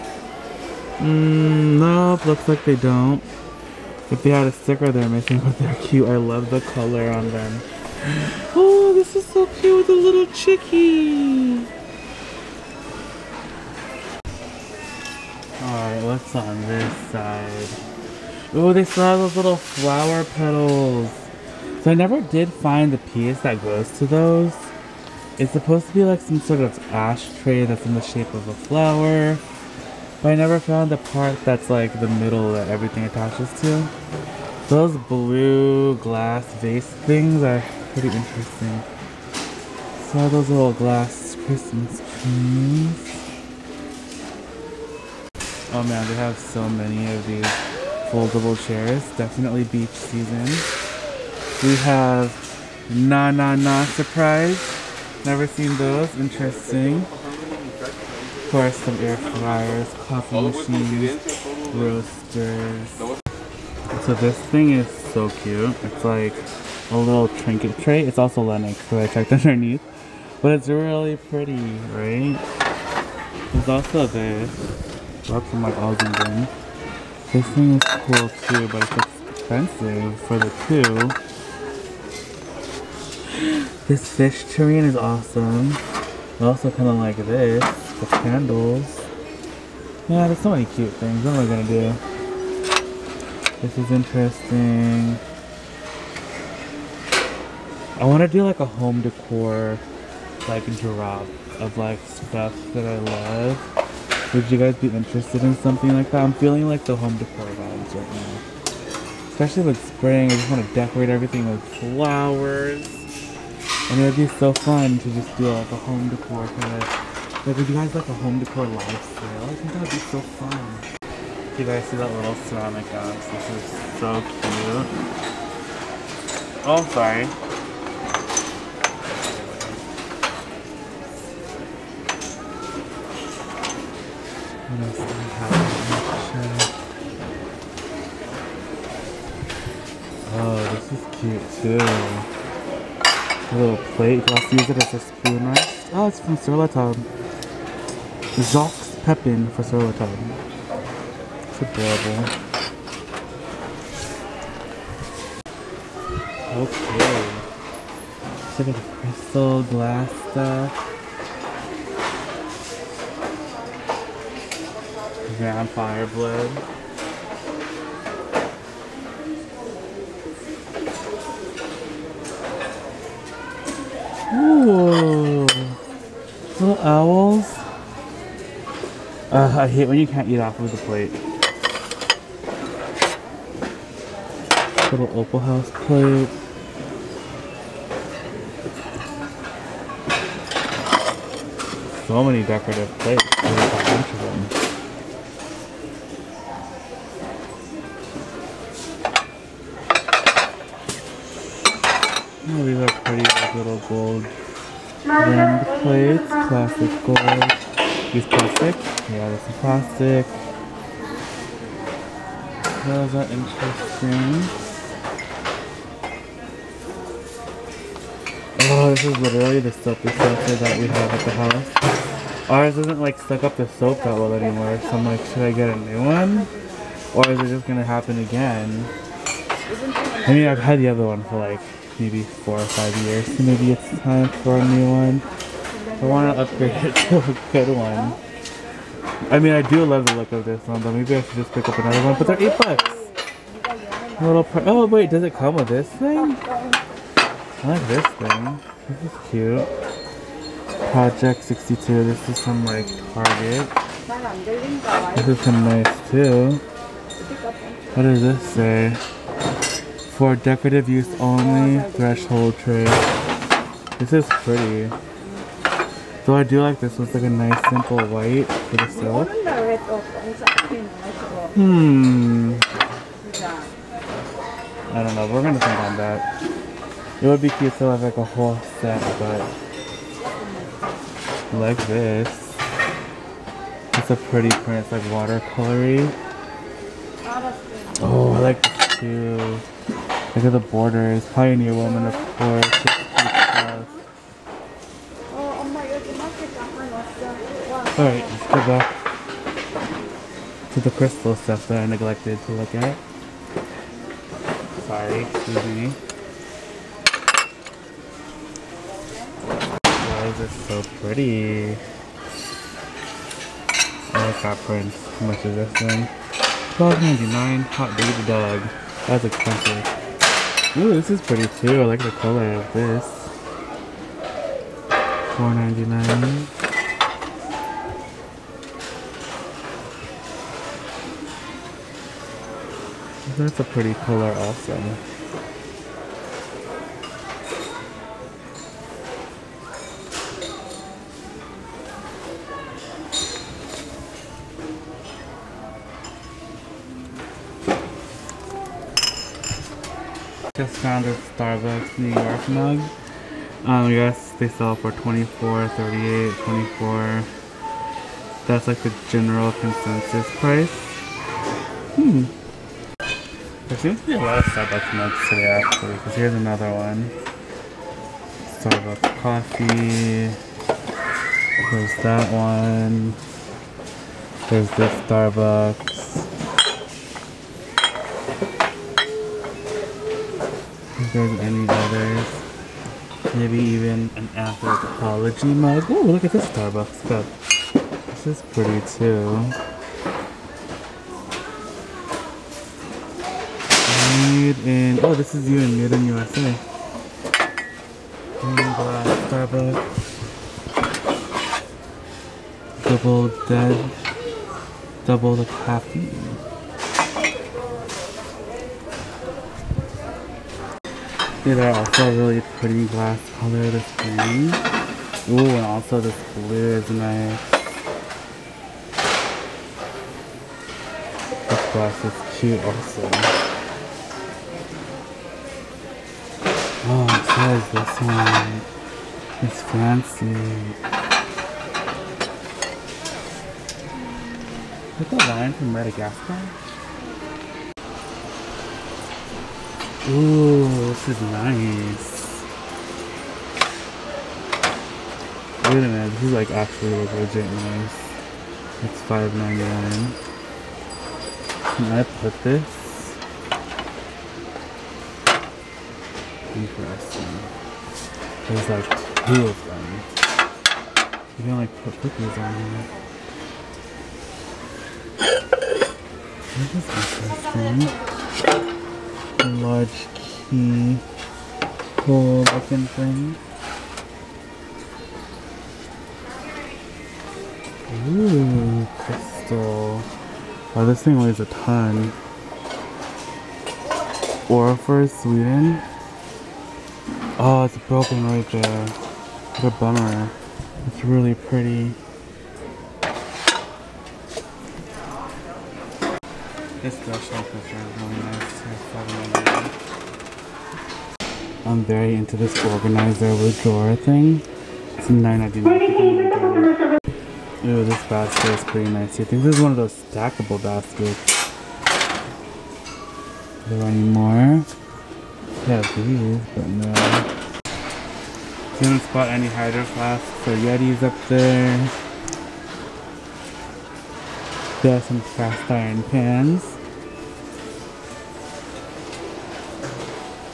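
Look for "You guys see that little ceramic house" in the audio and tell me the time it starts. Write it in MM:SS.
02:01.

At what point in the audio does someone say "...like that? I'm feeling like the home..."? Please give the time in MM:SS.
01:45.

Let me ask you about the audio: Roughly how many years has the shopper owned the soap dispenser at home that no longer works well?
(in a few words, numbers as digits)
4 or 5 years.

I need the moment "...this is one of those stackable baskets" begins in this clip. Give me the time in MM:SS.
08:29.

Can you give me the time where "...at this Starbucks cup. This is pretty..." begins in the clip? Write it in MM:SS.
06:26.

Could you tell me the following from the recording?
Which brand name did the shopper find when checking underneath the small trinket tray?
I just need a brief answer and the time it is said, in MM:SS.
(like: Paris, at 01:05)
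Lenox, at 01:08.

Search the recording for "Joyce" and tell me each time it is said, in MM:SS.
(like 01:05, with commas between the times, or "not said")
not said.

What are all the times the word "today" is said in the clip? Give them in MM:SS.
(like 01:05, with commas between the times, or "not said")
06:05.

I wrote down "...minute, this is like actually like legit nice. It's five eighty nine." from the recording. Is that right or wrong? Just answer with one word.
wrong.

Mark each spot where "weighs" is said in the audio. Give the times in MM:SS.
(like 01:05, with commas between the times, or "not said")
08:01.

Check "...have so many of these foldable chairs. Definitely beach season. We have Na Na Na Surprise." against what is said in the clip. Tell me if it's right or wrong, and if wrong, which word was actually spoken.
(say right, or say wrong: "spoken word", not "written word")
right.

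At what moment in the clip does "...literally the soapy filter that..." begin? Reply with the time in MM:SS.
03:39.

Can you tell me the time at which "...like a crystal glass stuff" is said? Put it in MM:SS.
02:38.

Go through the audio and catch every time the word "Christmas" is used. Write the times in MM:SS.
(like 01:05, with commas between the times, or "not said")
00:41.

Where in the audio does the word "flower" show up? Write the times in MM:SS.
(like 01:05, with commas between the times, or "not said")
00:19, 00:28, 01:51.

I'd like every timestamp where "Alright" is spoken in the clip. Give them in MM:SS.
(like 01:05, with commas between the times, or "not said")
00:15, 04:57.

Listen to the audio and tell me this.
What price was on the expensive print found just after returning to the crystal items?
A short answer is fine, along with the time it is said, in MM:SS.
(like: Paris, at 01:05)
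$12.99, at 05:16.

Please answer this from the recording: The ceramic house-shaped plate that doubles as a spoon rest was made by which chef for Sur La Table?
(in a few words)
Jacques Pepin.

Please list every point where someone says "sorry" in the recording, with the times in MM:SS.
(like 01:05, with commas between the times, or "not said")
02:06, 05:04.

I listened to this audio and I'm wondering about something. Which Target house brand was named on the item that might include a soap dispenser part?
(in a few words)
Project 62.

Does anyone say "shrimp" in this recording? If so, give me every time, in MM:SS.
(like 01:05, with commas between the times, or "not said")
not said.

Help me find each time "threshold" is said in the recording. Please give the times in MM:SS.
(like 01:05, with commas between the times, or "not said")
04:21, 08:16.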